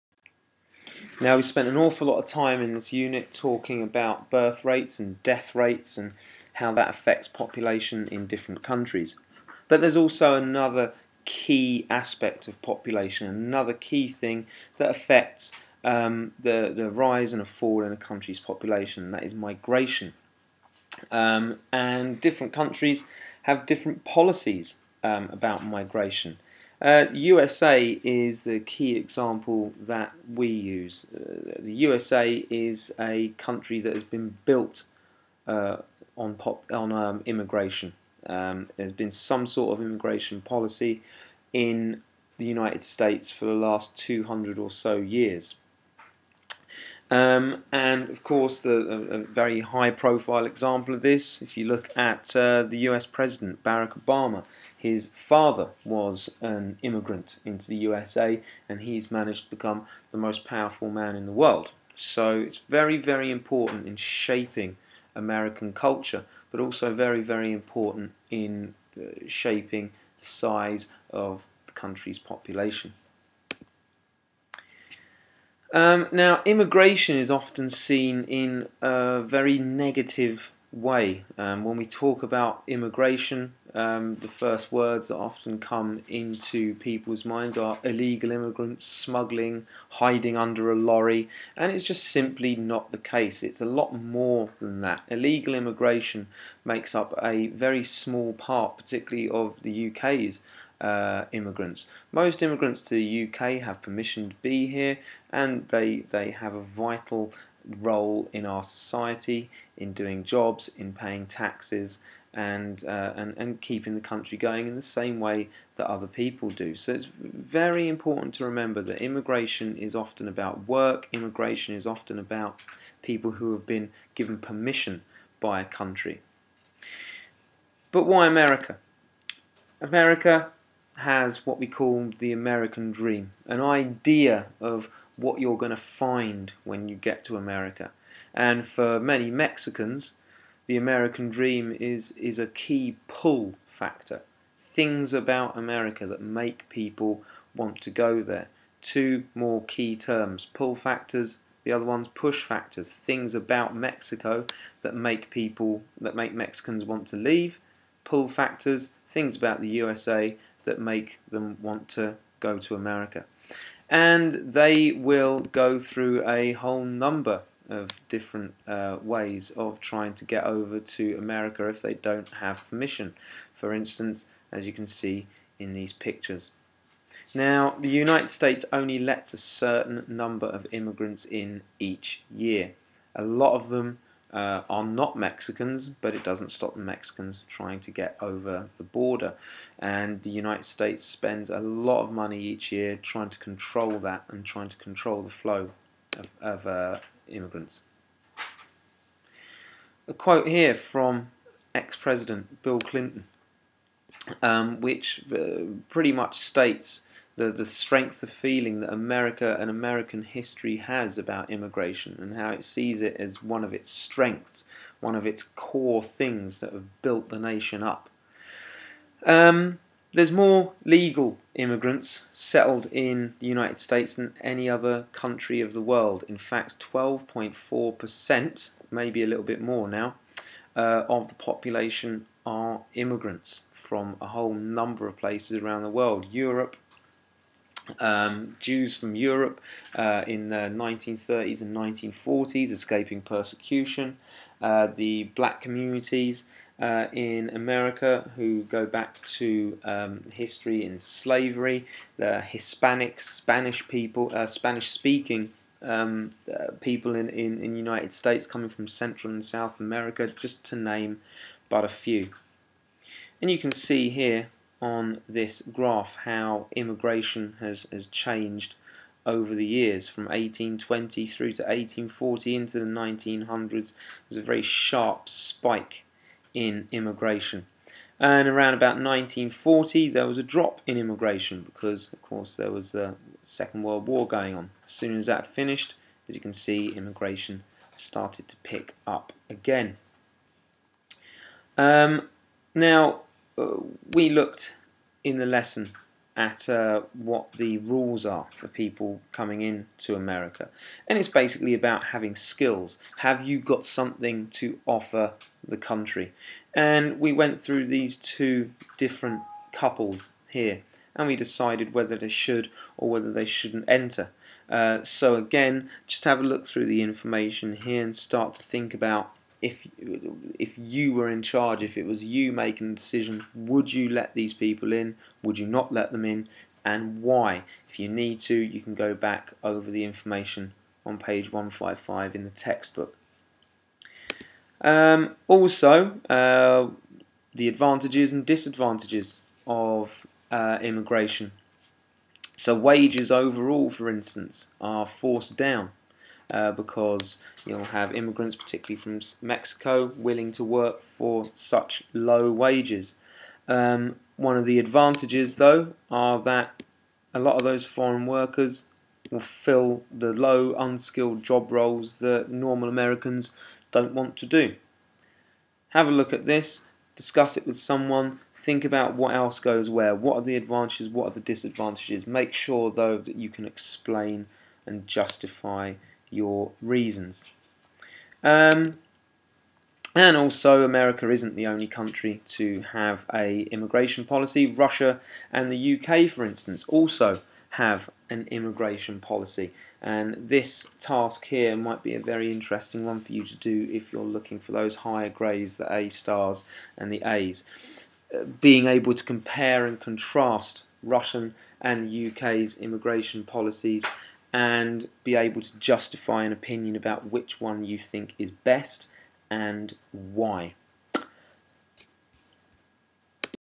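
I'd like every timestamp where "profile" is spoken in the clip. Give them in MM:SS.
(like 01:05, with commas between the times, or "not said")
00:49.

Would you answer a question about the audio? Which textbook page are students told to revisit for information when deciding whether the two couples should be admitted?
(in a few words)
155.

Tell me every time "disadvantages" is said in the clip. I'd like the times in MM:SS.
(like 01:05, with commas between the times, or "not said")
05:38, 06:11.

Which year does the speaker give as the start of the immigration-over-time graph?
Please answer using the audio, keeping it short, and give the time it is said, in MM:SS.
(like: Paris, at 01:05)
1820, at 04:30.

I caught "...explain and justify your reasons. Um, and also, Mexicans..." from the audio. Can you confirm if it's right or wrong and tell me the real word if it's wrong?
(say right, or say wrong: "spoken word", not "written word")
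wrong: "America", not "Mexicans".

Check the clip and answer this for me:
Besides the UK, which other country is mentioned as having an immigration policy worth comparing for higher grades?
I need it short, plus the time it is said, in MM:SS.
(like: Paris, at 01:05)
Russia, at 06:24.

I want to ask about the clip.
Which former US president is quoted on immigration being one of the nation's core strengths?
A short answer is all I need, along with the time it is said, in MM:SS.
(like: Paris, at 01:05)
Bill Clinton, at 03:22.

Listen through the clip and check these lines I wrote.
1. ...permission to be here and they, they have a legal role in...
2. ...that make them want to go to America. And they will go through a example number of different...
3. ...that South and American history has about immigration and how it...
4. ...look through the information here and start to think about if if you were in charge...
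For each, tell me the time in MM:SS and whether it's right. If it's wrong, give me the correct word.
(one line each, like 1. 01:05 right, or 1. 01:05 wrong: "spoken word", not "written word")
1. 01:43 wrong: "vital", not "legal"
2. 02:40 wrong: "whole", not "example"
3. 03:28 wrong: "America", not "South"
4. 05:16 right.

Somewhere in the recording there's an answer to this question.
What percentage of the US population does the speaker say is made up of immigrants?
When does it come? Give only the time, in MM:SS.
03:46.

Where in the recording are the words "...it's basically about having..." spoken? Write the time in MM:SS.
05:01.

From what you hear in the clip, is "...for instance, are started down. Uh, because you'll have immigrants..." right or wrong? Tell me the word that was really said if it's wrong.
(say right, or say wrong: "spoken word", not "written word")
wrong: "forced", not "started".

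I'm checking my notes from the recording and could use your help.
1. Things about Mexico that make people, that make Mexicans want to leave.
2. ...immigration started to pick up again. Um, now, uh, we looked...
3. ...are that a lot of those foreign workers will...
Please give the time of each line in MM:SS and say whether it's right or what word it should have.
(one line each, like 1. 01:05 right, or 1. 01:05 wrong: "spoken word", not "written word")
1. 02:32 right
2. 04:46 right
3. 05:56 right.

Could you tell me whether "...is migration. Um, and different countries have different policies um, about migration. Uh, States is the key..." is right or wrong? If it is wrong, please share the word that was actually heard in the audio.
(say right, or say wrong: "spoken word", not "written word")
wrong: "USA", not "States".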